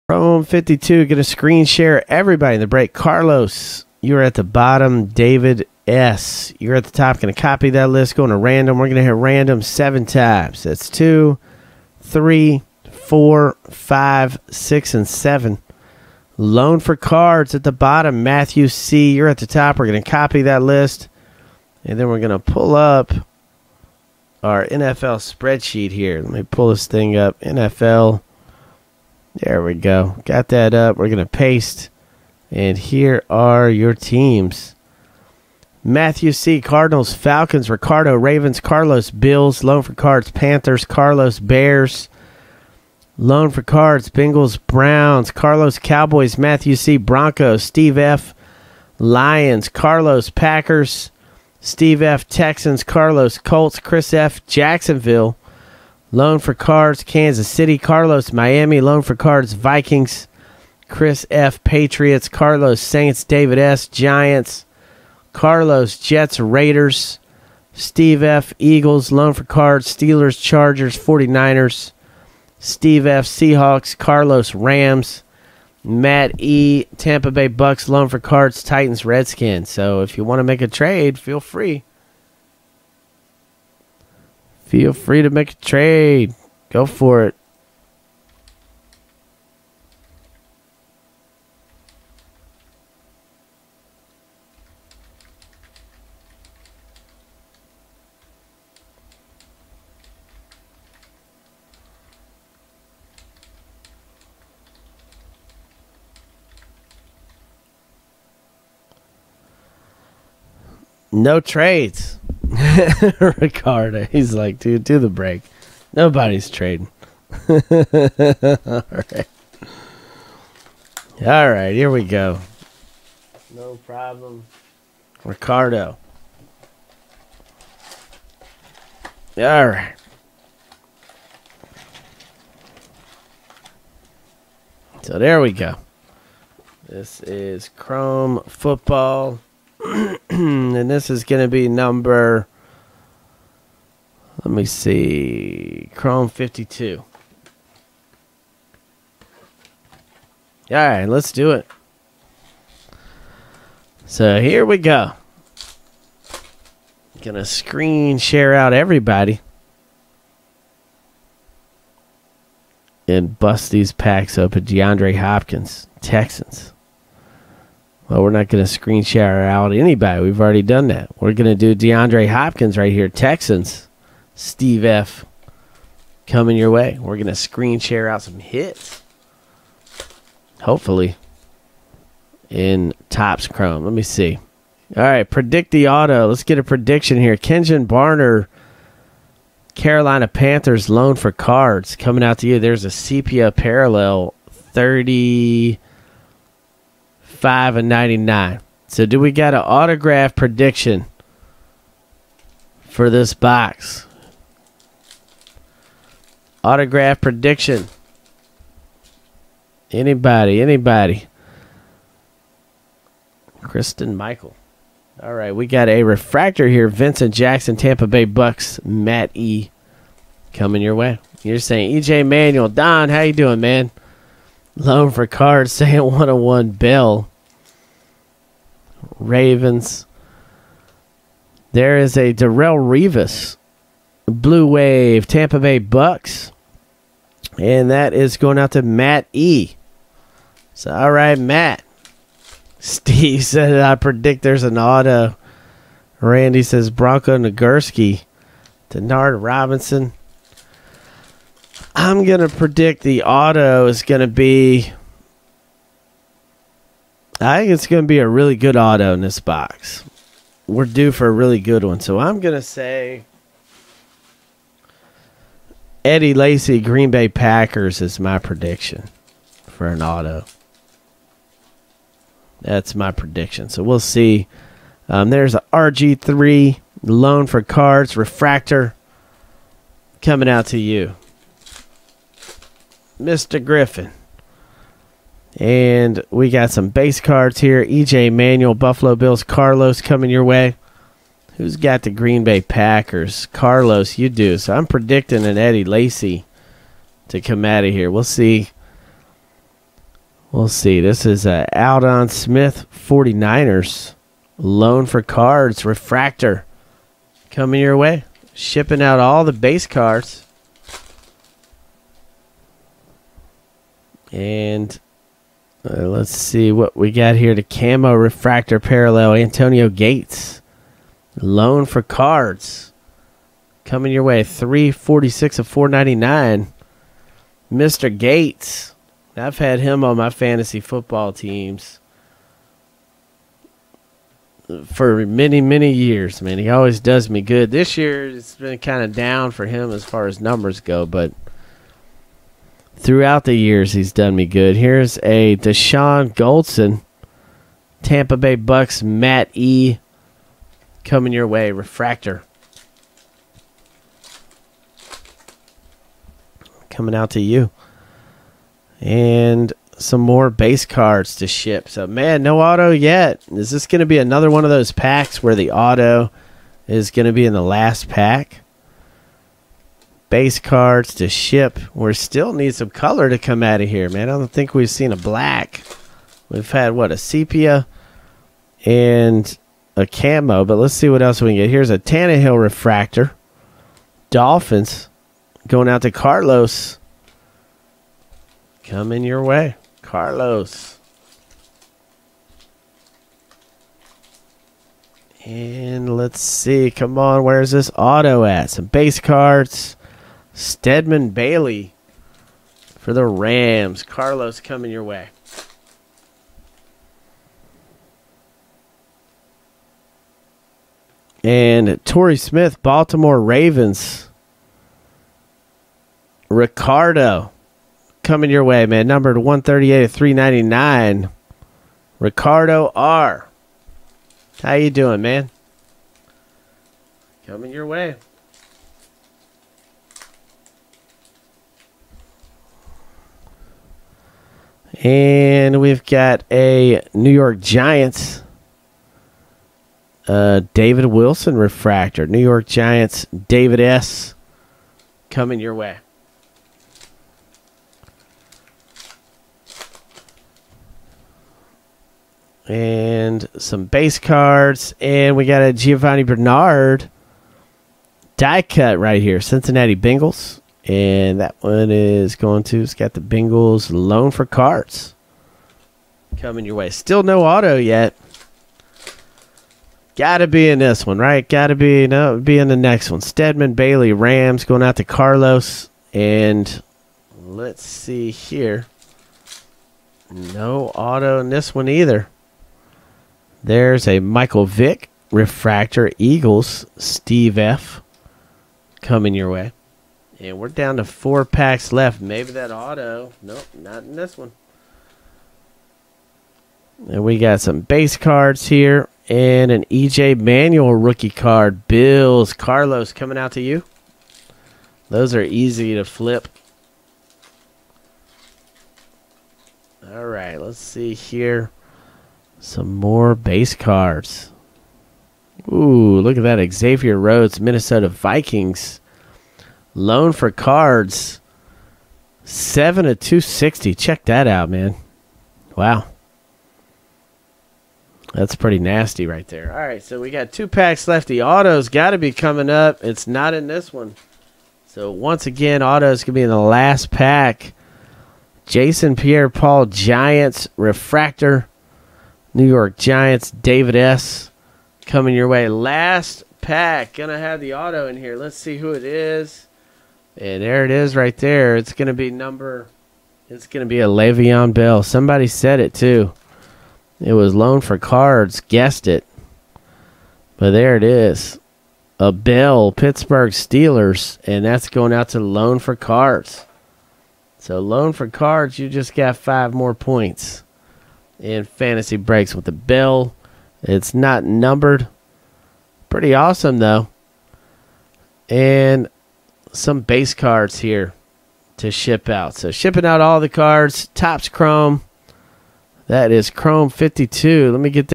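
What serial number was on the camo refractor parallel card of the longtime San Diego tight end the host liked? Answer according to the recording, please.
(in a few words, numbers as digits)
346 of 499.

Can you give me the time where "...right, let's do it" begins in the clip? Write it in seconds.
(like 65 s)
150 s.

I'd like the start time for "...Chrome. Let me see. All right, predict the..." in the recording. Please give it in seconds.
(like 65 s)
183 s.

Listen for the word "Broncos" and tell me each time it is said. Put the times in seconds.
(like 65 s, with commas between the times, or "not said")
46 s, 246 s.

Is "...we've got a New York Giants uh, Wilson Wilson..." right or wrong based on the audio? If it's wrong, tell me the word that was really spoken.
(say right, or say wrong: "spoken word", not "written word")
wrong: "David", not "Wilson".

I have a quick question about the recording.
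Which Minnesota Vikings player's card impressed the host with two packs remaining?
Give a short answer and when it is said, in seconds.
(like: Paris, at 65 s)
Xavier Rhodes, at 516 s.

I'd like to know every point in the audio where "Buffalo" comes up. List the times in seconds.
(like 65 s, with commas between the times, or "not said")
288 s.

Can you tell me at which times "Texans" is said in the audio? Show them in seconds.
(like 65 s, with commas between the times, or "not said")
52 s, 166 s, 173 s.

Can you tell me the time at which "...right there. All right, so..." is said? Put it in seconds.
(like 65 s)
529 s.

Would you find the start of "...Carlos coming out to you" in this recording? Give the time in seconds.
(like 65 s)
502 s.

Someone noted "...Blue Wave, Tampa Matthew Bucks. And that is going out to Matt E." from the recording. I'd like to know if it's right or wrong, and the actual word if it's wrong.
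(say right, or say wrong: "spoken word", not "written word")
wrong: "Bay", not "Matthew".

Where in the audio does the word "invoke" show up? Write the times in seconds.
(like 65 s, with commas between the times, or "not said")
not said.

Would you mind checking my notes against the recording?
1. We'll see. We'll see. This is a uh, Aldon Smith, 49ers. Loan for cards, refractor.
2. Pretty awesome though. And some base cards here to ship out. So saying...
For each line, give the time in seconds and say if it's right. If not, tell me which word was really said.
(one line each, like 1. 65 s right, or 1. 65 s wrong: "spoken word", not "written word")
1. 298 s right
2. 576 s wrong: "shipping", not "saying".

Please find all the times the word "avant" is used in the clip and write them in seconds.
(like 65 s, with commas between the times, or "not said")
not said.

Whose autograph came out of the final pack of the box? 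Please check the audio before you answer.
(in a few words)
Le'Veon Bell.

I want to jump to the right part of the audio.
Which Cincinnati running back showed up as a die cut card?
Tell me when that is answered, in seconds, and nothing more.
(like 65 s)
455 s.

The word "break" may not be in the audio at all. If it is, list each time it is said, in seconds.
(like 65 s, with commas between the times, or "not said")
2 s, 115 s, 572 s.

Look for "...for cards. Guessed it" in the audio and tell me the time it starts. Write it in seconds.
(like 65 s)
557 s.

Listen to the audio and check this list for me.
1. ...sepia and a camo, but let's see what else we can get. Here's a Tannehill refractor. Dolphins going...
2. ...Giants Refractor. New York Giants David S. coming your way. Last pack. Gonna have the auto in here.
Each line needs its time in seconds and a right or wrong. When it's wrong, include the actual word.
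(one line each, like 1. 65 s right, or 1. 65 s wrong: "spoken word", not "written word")
1. 377 s right
2. 539 s right.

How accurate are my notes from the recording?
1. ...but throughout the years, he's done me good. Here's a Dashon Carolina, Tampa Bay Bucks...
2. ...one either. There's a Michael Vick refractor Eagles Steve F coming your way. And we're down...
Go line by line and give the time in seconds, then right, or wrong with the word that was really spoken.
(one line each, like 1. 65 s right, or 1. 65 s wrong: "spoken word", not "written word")
1. 341 s wrong: "Goldson", not "Carolina"
2. 481 s right.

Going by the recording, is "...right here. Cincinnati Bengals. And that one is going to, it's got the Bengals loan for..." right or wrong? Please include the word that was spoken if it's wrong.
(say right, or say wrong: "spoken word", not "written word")
right.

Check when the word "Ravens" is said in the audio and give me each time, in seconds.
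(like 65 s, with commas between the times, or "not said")
38 s, 229 s, 413 s.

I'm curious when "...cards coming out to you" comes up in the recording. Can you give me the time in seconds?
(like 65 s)
191 s.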